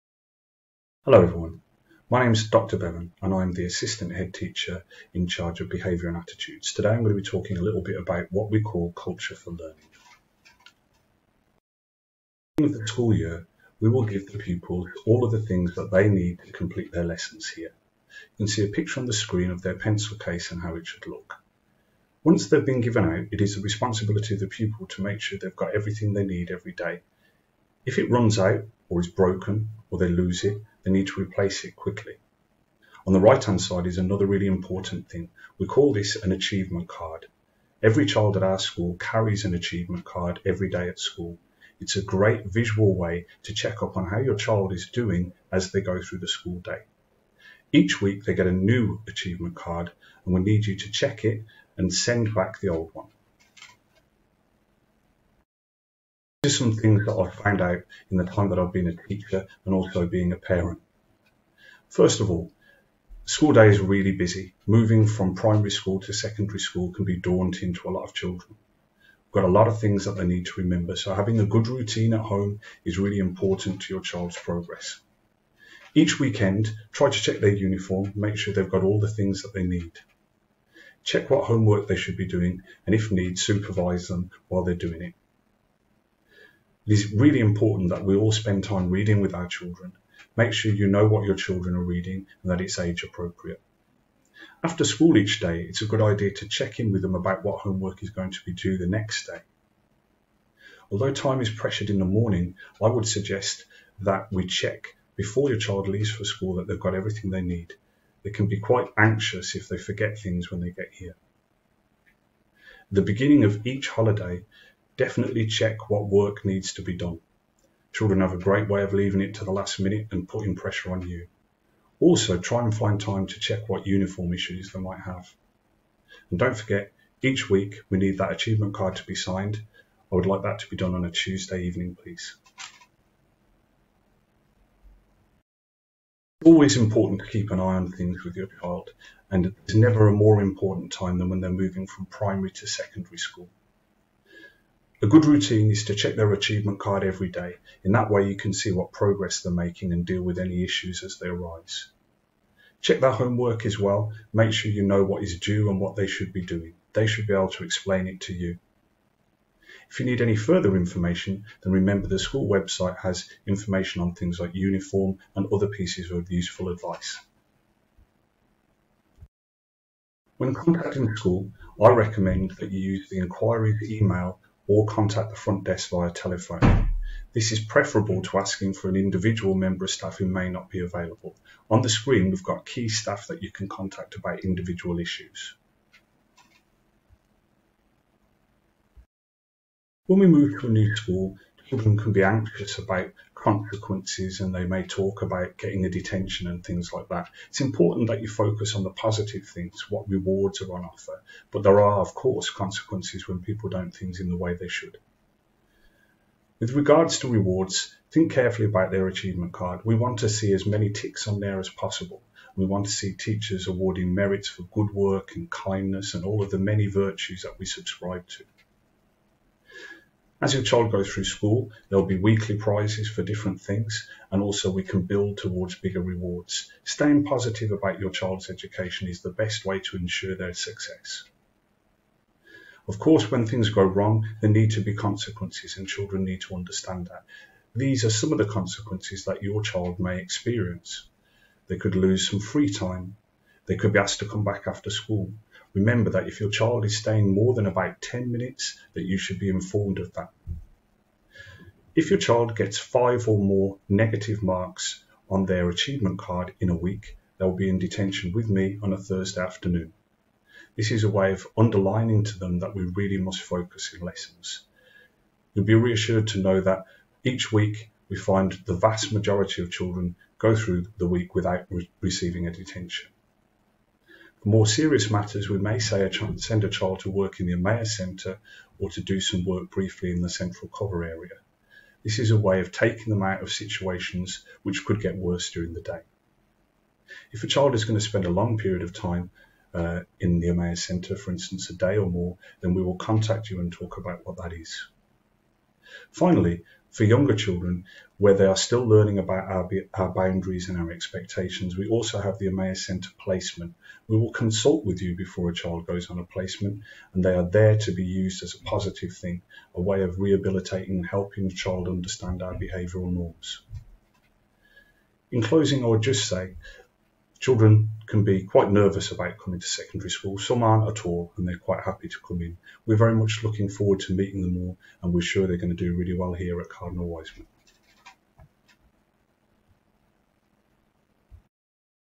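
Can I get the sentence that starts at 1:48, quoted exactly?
They can be quite anxious if they forget things when they get here.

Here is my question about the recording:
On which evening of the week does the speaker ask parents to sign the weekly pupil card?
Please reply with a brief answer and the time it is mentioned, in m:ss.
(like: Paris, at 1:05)
Tuesday, at 2:11.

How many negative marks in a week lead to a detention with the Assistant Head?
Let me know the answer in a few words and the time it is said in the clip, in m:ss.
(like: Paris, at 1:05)
5, at 4:12.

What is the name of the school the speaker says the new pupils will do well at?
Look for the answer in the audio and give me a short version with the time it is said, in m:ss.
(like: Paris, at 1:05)
Cardinal Wiseman, at 5:26.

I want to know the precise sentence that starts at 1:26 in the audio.
It is really important that we all spend time reading with our children.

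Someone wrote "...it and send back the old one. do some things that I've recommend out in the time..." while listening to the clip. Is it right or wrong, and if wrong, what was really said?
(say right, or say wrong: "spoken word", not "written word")
wrong: "found", not "recommend".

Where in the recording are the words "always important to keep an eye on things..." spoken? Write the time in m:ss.
2:16.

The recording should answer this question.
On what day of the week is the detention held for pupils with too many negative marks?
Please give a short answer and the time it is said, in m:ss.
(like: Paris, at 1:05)
Thursday, at 4:18.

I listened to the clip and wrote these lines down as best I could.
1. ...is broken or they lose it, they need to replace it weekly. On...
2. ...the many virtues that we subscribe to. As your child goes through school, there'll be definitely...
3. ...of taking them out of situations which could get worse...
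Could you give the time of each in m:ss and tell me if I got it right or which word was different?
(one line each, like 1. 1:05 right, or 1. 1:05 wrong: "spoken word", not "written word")
1. 0:28 wrong: "quickly", not "weekly"
2. 3:36 wrong: "weekly", not "definitely"
3. 4:42 right.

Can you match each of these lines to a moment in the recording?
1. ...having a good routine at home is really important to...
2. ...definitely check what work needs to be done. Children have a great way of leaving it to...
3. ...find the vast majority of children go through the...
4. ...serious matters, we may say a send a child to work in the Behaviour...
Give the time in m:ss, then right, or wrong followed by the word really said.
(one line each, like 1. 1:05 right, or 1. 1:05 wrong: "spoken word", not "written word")
1. 1:11 right
2. 1:54 right
3. 4:28 right
4. 4:34 wrong: "Amaya", not "Behaviour".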